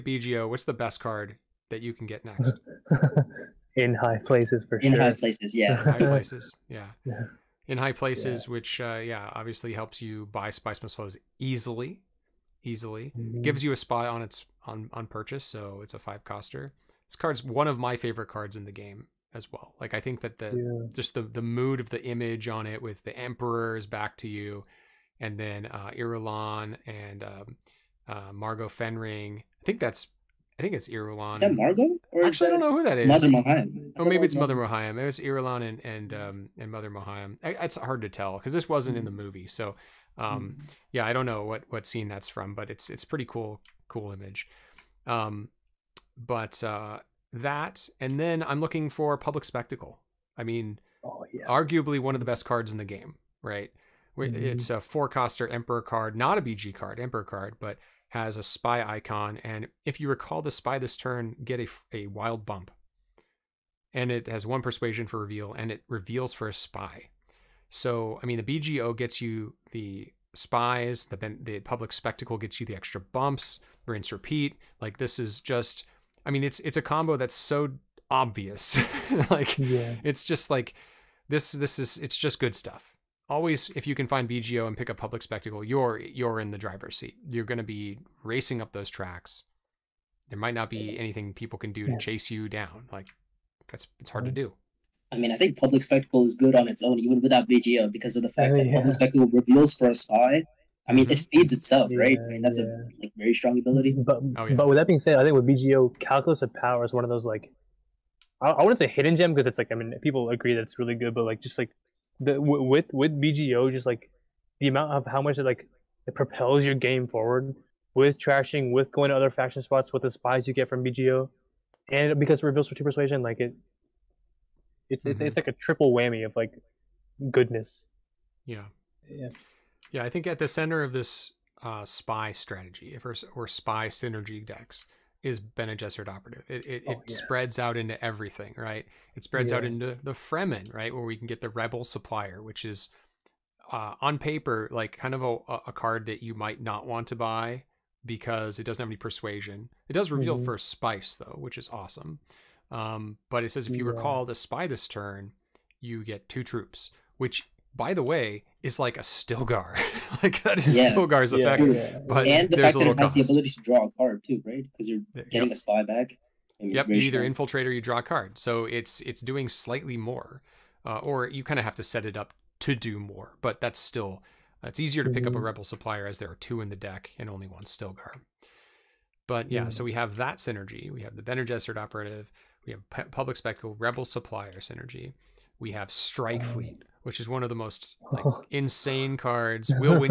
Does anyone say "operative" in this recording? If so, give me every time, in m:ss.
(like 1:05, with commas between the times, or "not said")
2:16, 3:01.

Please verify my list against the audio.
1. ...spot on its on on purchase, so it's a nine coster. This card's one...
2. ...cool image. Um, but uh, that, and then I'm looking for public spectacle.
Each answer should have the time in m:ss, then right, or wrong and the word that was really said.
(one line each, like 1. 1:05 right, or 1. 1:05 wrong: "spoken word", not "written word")
1. 0:13 wrong: "five", not "nine"
2. 0:43 right.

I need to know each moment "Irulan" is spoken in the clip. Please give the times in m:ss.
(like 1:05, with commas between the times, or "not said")
0:25, 0:30, 0:35.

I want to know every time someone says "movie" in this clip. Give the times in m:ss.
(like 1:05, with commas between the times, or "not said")
0:39.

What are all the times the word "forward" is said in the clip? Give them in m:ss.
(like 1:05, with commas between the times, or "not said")
1:57.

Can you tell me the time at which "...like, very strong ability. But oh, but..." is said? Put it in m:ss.
1:43.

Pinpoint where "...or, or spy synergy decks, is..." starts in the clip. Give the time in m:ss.
2:13.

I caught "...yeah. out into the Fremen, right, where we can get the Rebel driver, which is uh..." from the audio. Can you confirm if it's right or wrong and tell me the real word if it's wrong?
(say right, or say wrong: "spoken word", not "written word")
wrong: "supplier", not "driver".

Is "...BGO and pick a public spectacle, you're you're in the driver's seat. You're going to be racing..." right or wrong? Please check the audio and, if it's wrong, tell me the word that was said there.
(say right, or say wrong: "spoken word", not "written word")
right.